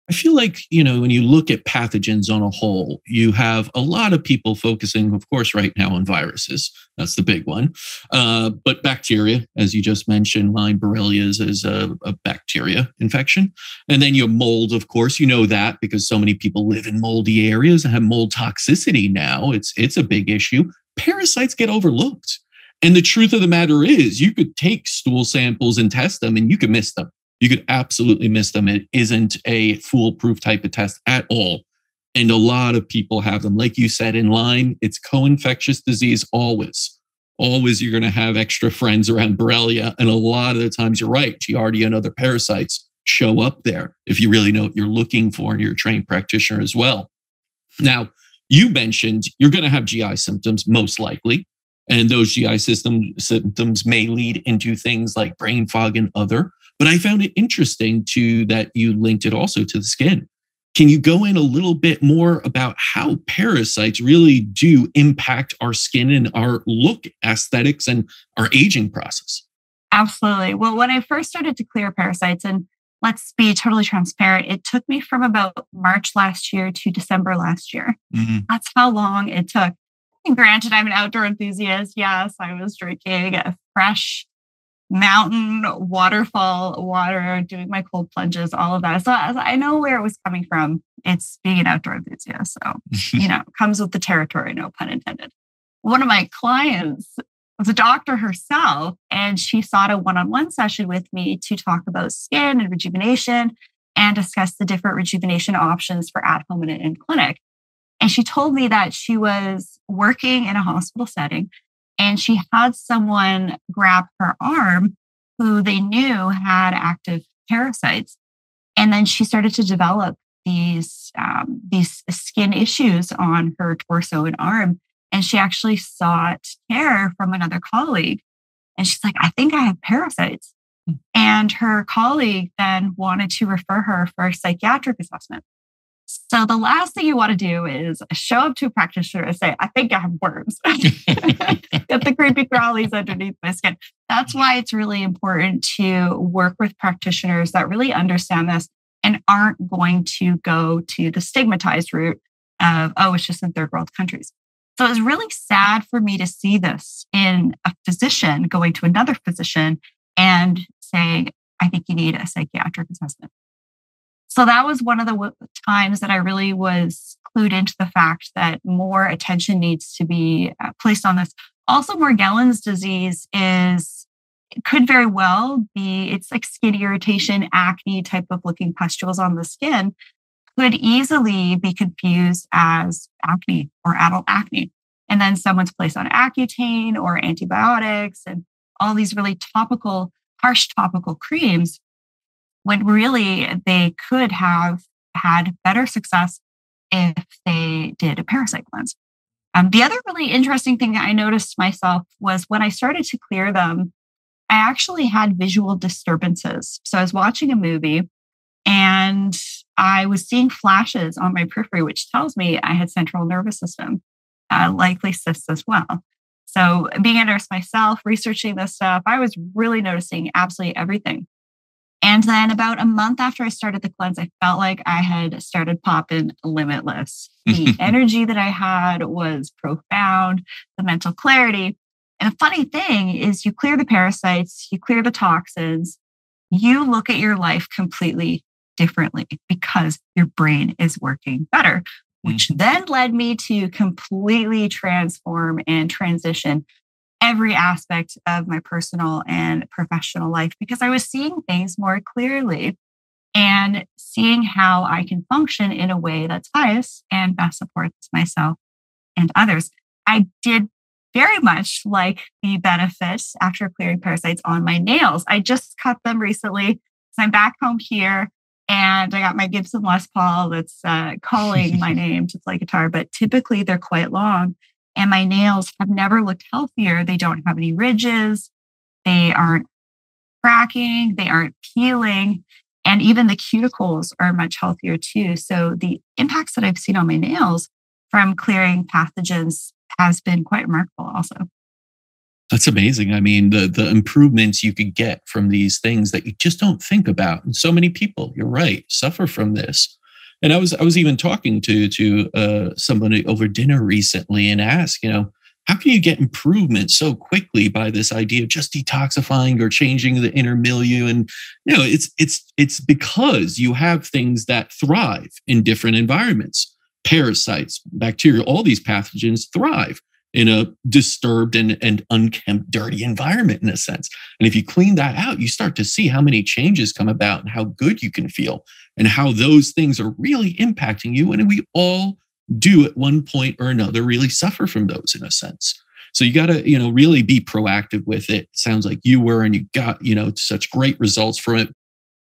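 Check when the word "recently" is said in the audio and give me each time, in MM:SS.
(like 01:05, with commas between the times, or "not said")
04:26, 05:03.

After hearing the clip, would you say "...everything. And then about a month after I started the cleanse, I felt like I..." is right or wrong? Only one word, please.
right.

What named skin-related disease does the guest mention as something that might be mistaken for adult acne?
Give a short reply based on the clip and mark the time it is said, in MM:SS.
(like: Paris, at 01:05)
Morgellons disease, at 02:51.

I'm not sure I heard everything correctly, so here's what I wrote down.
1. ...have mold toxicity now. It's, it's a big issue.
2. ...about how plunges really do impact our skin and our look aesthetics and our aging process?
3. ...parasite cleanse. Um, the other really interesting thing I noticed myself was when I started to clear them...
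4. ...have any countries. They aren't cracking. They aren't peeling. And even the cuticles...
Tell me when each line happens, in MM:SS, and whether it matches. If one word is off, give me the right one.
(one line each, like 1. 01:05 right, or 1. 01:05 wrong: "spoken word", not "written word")
1. 00:17 right
2. 01:02 wrong: "parasites", not "plunges"
3. 03:18 right
4. 04:37 wrong: "ridges", not "countries".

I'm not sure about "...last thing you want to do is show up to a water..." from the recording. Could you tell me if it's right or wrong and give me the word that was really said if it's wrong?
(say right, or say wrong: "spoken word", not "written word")
wrong: "practitioner", not "water".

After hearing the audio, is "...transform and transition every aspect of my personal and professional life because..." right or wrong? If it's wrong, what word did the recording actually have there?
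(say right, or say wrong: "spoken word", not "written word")
right.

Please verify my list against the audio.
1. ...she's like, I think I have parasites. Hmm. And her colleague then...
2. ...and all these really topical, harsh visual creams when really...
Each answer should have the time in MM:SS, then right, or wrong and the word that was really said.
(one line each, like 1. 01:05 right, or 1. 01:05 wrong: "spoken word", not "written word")
1. 02:08 right
2. 03:08 wrong: "topical", not "visual".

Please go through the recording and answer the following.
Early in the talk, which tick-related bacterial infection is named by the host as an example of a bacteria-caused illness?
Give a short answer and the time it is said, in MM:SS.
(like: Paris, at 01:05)
Lyme borreliosis, at 00:10.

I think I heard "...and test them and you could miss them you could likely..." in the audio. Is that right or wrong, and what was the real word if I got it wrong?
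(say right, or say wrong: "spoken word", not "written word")
wrong: "absolutely", not "likely".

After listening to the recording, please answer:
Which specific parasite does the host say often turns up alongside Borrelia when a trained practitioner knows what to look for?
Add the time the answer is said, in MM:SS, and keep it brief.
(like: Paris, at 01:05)
Giardia, at 00:41.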